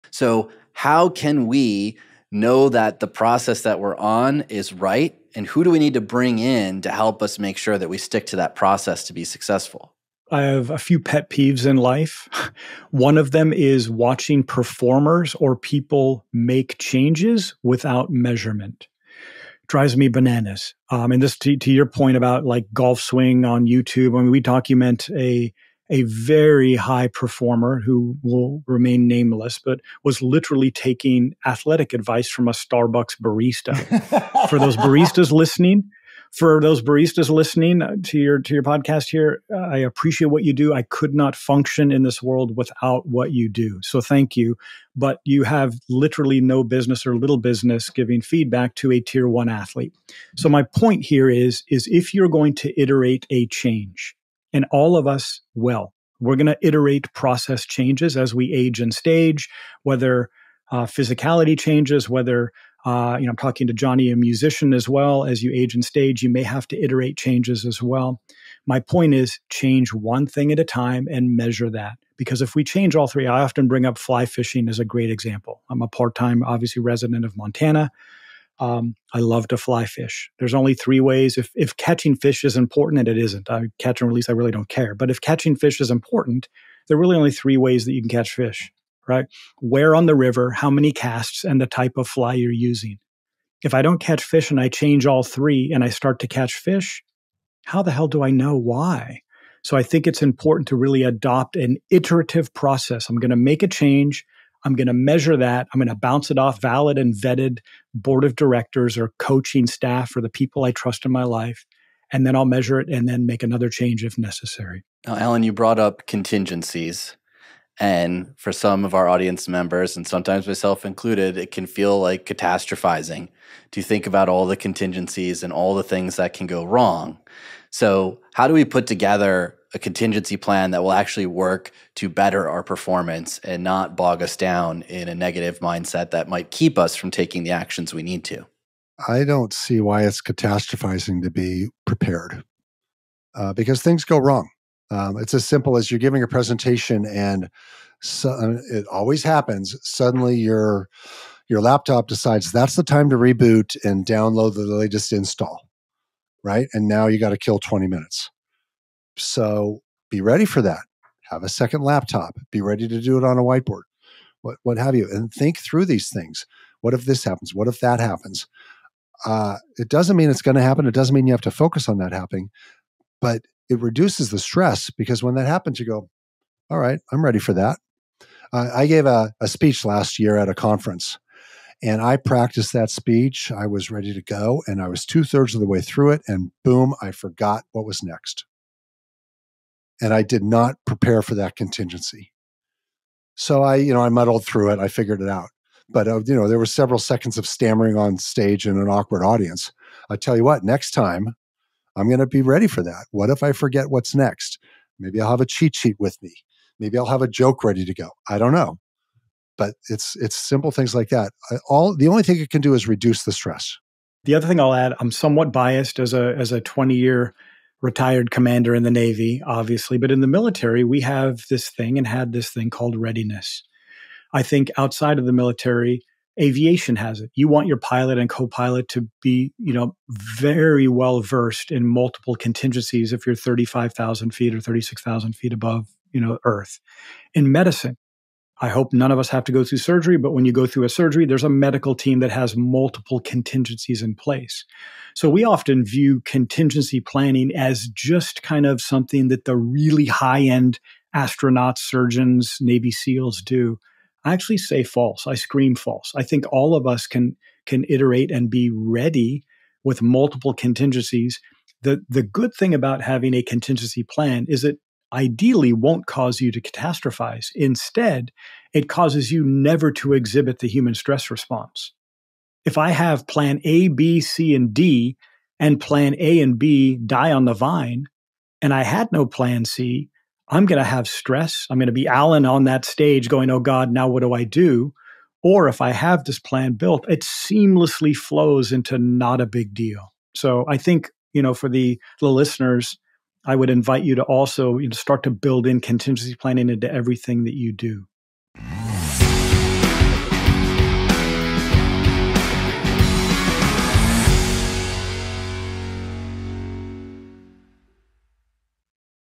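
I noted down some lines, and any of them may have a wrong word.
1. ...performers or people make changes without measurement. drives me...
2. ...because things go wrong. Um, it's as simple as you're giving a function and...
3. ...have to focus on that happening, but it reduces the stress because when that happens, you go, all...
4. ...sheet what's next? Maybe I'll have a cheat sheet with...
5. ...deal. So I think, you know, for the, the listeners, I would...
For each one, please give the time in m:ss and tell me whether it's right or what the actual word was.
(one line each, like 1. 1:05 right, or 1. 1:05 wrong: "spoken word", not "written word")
1. 0:14 right
2. 2:23 wrong: "presentation", not "function"
3. 2:51 right
4. 3:23 wrong: "forget", not "sheet"
5. 4:49 right.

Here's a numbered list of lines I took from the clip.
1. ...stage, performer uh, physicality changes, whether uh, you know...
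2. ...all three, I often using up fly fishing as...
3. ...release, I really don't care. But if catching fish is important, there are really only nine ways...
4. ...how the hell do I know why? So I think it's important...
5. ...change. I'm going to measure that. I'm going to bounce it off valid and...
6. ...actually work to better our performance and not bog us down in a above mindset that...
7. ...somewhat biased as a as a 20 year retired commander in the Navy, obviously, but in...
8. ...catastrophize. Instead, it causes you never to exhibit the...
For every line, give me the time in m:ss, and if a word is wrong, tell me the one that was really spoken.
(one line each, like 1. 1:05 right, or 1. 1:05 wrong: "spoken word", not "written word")
1. 0:58 wrong: "whether", not "performer"
2. 1:12 wrong: "bring", not "using"
3. 1:24 wrong: "three", not "nine"
4. 1:37 right
5. 1:43 right
6. 2:10 wrong: "negative", not "above"
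7. 3:35 right
8. 4:26 right.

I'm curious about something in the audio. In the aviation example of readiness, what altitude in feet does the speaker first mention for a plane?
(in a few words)
35,000.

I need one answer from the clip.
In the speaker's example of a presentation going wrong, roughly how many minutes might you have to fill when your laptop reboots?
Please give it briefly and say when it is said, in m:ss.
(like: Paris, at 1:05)
20 minutes, at 2:37.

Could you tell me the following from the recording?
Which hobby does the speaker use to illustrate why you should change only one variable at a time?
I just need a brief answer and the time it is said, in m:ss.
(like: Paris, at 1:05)
Fly fishing, at 1:19.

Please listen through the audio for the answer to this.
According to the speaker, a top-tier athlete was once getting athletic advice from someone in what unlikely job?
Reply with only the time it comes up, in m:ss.
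0:32.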